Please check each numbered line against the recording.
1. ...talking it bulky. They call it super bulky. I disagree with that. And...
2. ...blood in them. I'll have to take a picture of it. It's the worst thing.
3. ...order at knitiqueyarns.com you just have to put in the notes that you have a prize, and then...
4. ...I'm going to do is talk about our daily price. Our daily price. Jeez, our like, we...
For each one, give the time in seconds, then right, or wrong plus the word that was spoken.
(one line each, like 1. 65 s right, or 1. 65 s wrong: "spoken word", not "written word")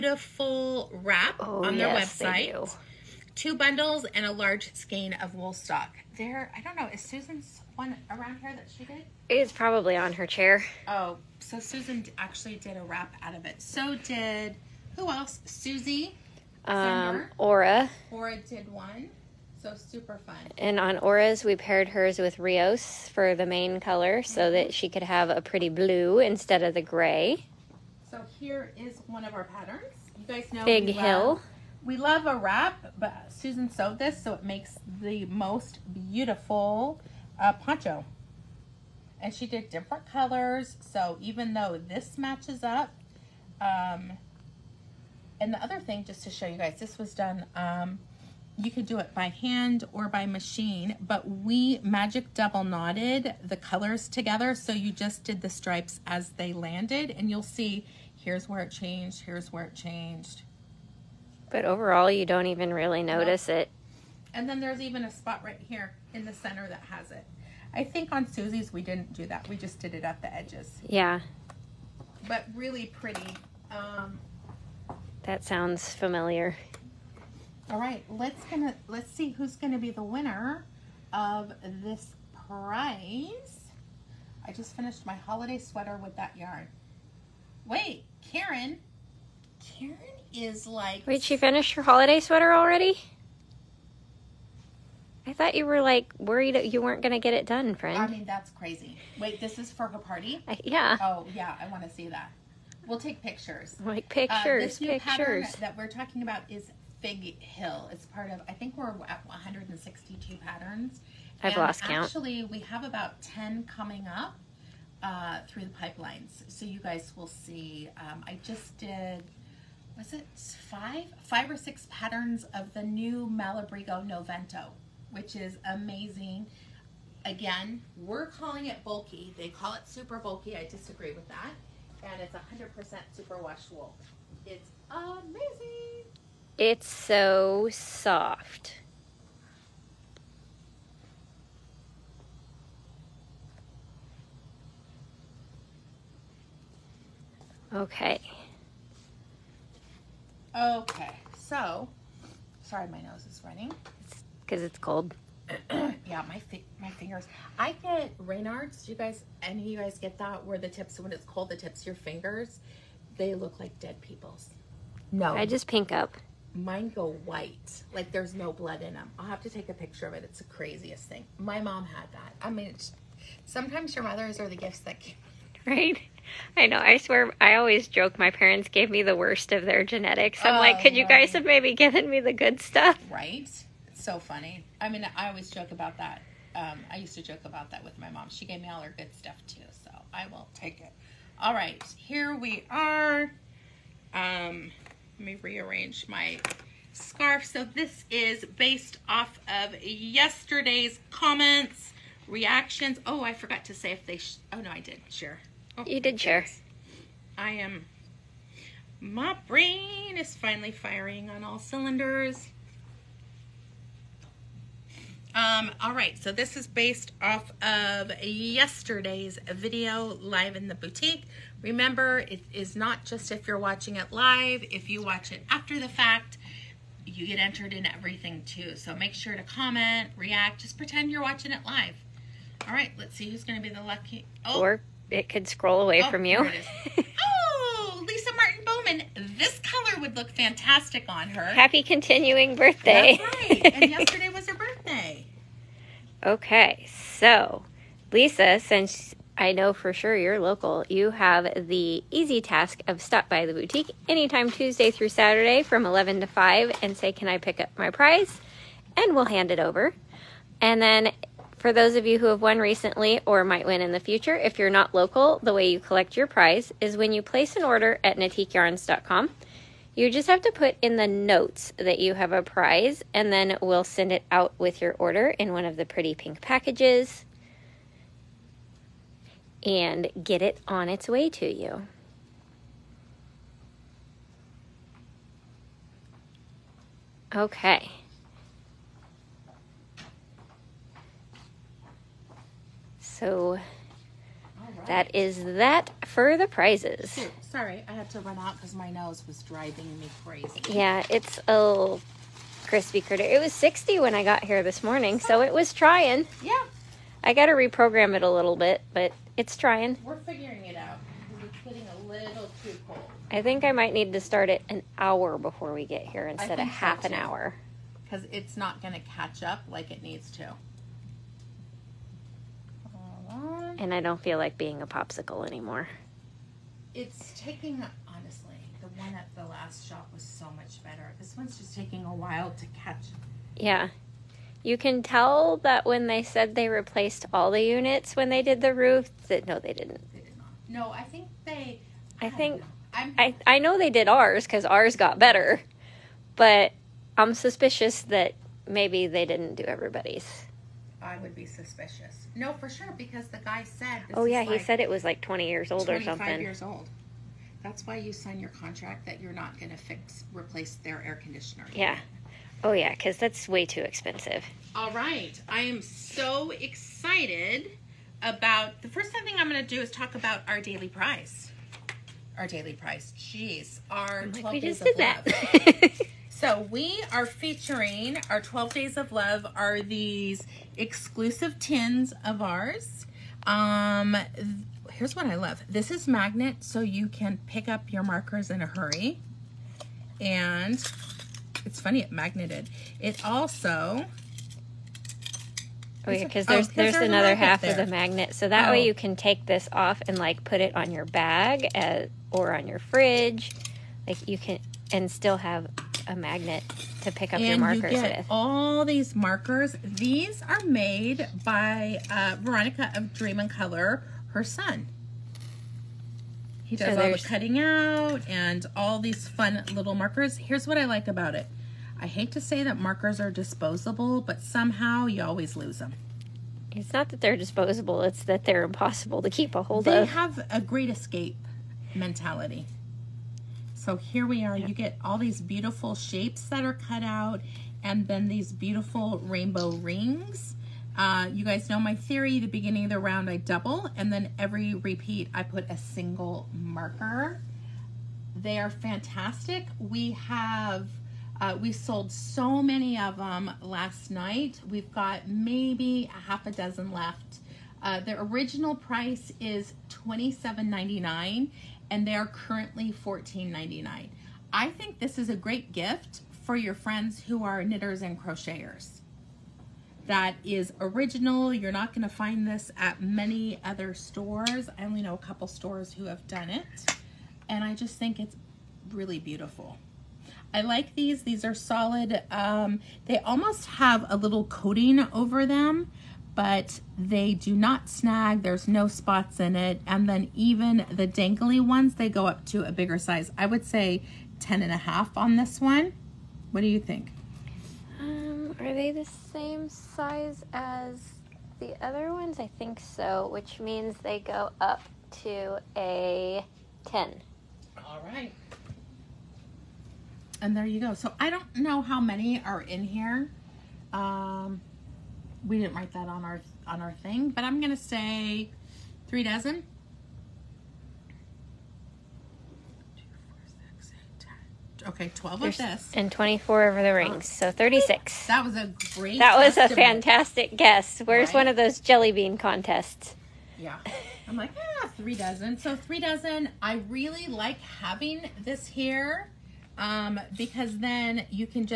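1. 128 s wrong: "calling", not "talking"
2. 168 s wrong: "craziest", not "worst"
3. 267 s right
4. 369 s right.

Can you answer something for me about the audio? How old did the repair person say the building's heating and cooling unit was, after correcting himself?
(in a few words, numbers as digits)
25 years.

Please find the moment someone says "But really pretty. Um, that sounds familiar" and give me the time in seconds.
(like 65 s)
72 s.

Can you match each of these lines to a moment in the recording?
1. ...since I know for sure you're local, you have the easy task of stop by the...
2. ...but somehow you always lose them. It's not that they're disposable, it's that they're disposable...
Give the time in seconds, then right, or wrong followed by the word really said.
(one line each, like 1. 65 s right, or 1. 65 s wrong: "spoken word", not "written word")
1. 248 s right
2. 424 s wrong: "impossible", not "disposable".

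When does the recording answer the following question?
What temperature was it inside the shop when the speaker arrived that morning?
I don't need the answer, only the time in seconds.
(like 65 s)
303 s.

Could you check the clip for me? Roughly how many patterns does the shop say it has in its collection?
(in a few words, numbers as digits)
162.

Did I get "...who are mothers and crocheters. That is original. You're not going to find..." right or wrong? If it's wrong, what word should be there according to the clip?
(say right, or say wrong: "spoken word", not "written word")
wrong: "knitters", not "mothers".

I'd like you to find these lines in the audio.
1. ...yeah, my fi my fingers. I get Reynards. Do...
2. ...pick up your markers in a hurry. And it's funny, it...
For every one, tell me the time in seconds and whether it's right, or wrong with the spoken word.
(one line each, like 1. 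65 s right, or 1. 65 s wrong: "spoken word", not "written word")
1. 156 s right
2. 387 s right.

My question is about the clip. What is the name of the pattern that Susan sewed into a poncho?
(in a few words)
Fig Hill.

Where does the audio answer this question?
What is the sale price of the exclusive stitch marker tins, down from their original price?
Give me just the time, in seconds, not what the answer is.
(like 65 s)
462 s.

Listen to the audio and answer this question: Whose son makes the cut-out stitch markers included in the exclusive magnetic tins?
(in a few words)
Veronica.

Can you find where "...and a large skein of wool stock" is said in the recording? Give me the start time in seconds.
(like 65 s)
4 s.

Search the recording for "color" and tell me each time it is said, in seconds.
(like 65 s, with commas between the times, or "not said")
23 s, 40 s, 53 s, 239 s, 413 s.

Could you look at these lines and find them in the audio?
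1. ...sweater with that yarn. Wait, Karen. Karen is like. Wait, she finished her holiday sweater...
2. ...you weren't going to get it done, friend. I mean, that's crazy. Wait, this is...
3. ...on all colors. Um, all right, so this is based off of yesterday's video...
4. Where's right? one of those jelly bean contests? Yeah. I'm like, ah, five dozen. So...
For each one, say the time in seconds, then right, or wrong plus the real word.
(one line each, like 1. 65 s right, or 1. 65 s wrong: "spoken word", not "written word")
1. 85 s right
2. 96 s right
3. 211 s wrong: "cylinders", not "colors"
4. 531 s wrong: "three", not "five".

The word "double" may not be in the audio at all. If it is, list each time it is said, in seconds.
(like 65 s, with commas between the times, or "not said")
52 s, 443 s.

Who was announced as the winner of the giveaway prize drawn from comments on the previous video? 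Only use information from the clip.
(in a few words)
Lisa Martin Bowman.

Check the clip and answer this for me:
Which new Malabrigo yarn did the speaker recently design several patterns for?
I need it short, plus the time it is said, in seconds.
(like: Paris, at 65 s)
Noventa, at 124 s.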